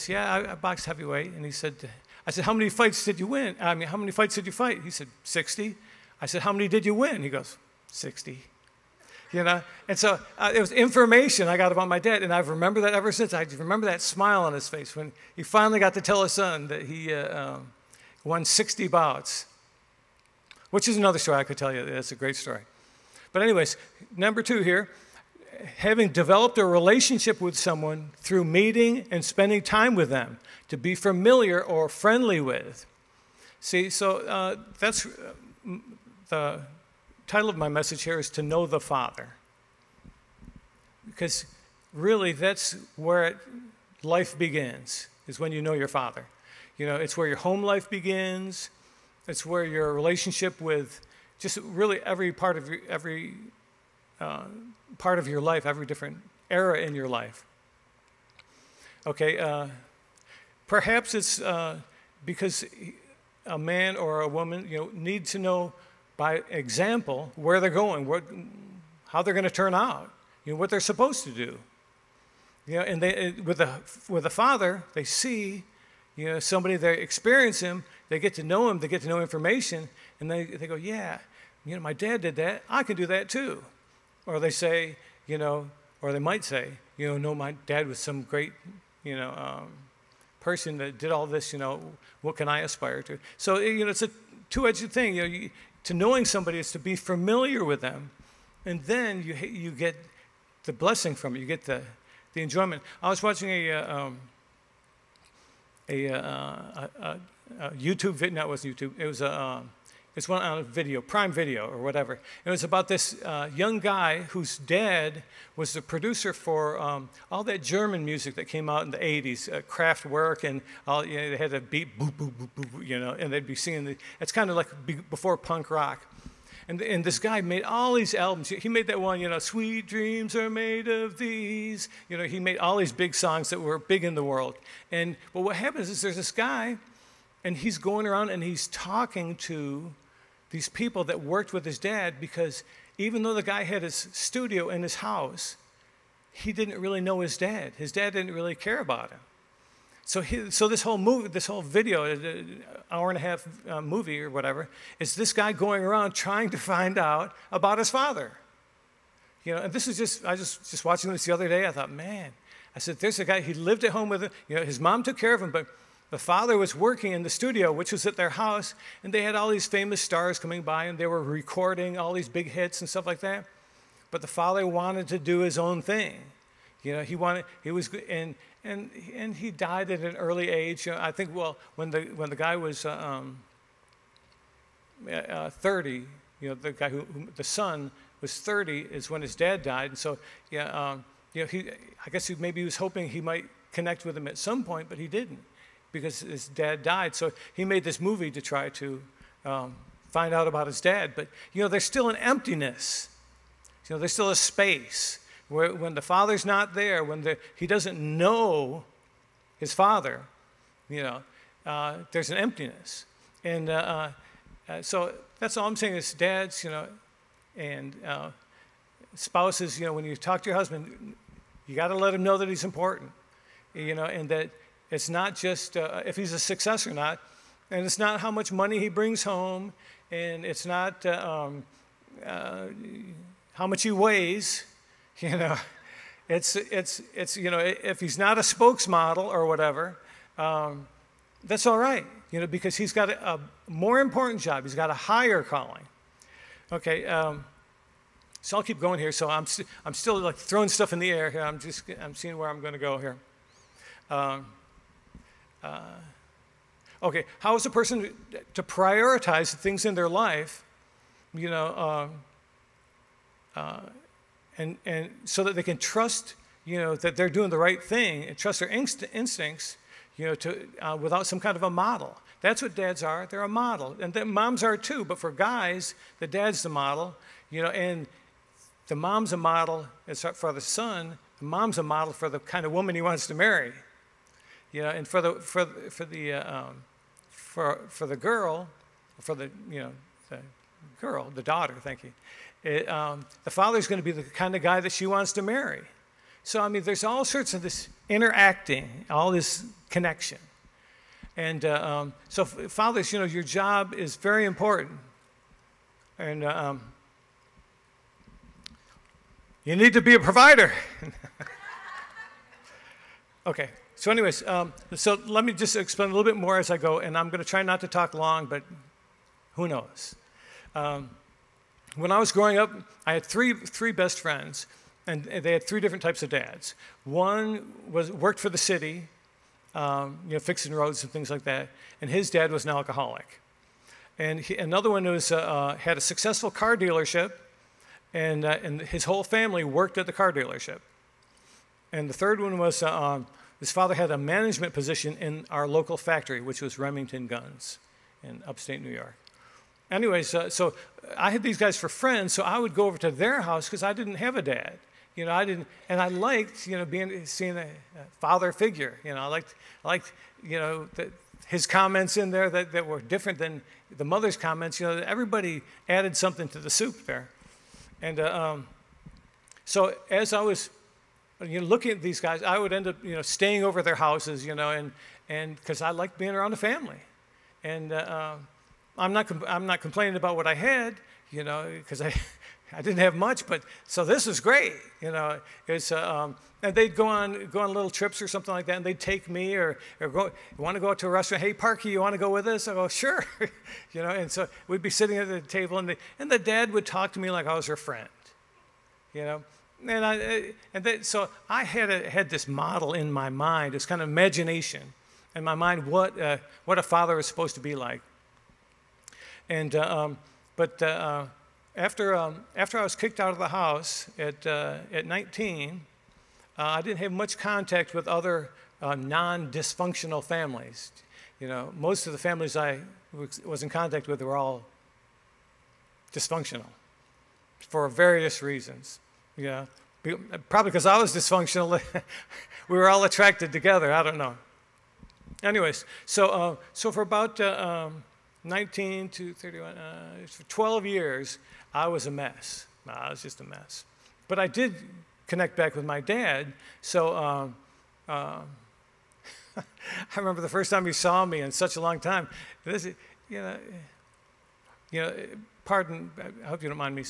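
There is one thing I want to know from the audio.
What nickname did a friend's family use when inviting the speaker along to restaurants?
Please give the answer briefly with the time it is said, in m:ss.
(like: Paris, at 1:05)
Parky, at 6:31.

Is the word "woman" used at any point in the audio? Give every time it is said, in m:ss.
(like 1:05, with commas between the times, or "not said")
1:04, 4:42.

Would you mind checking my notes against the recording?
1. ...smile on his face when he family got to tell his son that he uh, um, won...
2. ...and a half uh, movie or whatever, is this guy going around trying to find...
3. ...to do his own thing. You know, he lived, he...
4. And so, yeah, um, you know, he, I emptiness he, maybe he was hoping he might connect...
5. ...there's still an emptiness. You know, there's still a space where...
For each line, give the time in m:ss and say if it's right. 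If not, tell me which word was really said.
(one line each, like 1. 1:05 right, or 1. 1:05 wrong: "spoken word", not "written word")
1. 0:14 wrong: "finally", not "family"
2. 2:33 right
3. 2:55 wrong: "wanted", not "lived"
4. 3:09 wrong: "guess", not "emptiness"
5. 3:21 right.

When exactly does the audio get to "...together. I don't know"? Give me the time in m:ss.
7:13.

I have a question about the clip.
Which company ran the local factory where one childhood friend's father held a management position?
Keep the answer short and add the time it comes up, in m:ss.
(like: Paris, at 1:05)
Remington Guns, at 5:46.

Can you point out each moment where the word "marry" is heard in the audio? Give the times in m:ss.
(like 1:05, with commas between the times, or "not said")
4:43, 4:55.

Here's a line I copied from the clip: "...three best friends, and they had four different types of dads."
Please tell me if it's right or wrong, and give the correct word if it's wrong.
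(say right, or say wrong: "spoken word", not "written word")
wrong: "three", not "four".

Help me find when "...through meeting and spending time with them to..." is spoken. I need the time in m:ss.
0:28.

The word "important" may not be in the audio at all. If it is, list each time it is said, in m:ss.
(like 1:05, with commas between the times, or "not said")
3:42, 4:03, 5:04.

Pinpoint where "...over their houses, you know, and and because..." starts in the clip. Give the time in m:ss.
6:13.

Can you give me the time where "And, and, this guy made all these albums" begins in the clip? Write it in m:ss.
2:06.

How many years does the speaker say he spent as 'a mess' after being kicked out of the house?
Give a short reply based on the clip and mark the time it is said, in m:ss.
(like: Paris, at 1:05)
12, at 7:20.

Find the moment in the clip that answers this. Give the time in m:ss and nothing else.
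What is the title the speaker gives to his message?
0:38.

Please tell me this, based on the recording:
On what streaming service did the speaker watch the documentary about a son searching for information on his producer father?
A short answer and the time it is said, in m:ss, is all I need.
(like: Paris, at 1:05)
Prime Video, at 1:51.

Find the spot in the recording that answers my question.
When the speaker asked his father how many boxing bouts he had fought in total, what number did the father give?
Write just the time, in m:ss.
0:05.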